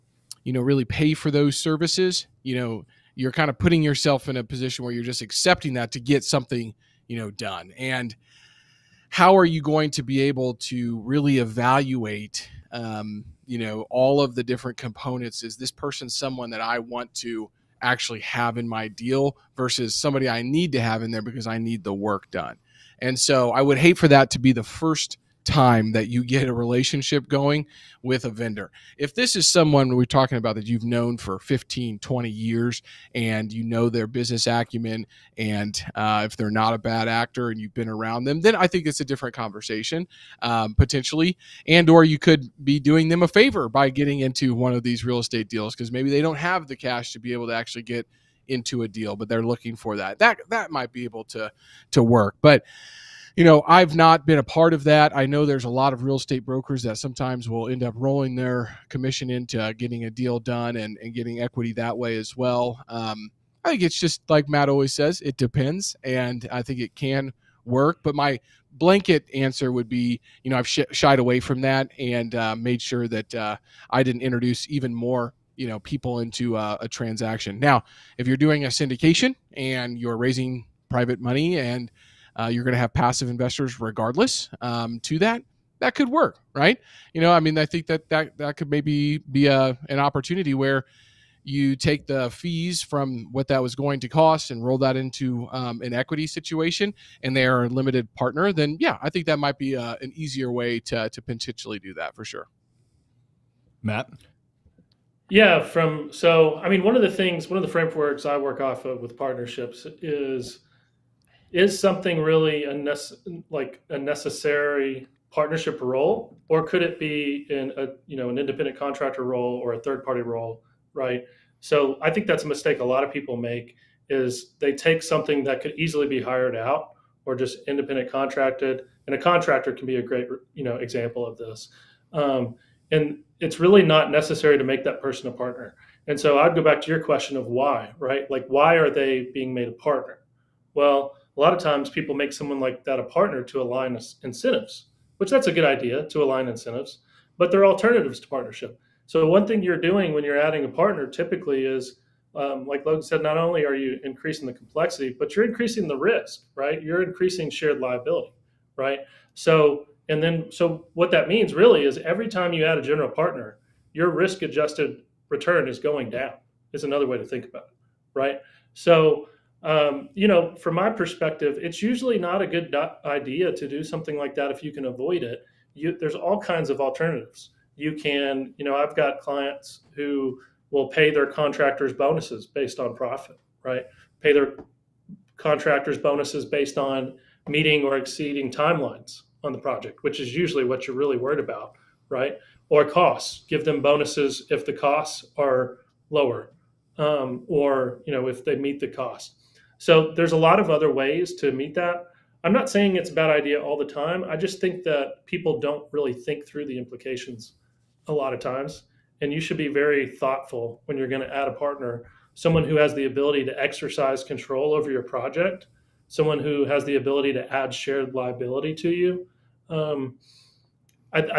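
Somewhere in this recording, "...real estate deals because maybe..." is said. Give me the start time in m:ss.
0:45.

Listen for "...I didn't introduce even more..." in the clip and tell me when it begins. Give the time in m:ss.
1:13.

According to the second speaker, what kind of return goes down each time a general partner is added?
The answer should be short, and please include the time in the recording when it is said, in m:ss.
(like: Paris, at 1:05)
Risk adjusted return, at 2:44.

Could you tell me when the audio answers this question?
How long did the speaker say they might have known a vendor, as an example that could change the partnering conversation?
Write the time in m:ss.
0:31.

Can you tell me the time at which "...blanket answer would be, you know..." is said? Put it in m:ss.
1:08.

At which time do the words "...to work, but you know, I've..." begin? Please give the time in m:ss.
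0:51.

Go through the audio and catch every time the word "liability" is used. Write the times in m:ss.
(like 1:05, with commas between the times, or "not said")
2:37, 3:38.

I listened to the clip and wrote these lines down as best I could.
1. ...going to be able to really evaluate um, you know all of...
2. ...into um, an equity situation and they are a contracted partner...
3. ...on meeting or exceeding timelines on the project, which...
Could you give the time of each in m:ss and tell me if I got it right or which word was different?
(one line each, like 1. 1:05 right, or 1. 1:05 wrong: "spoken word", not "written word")
1. 0:09 right
2. 1:34 wrong: "limited", not "contracted"
3. 3:06 right.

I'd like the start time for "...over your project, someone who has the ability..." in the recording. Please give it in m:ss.
3:34.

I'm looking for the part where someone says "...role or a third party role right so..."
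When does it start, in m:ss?
1:59.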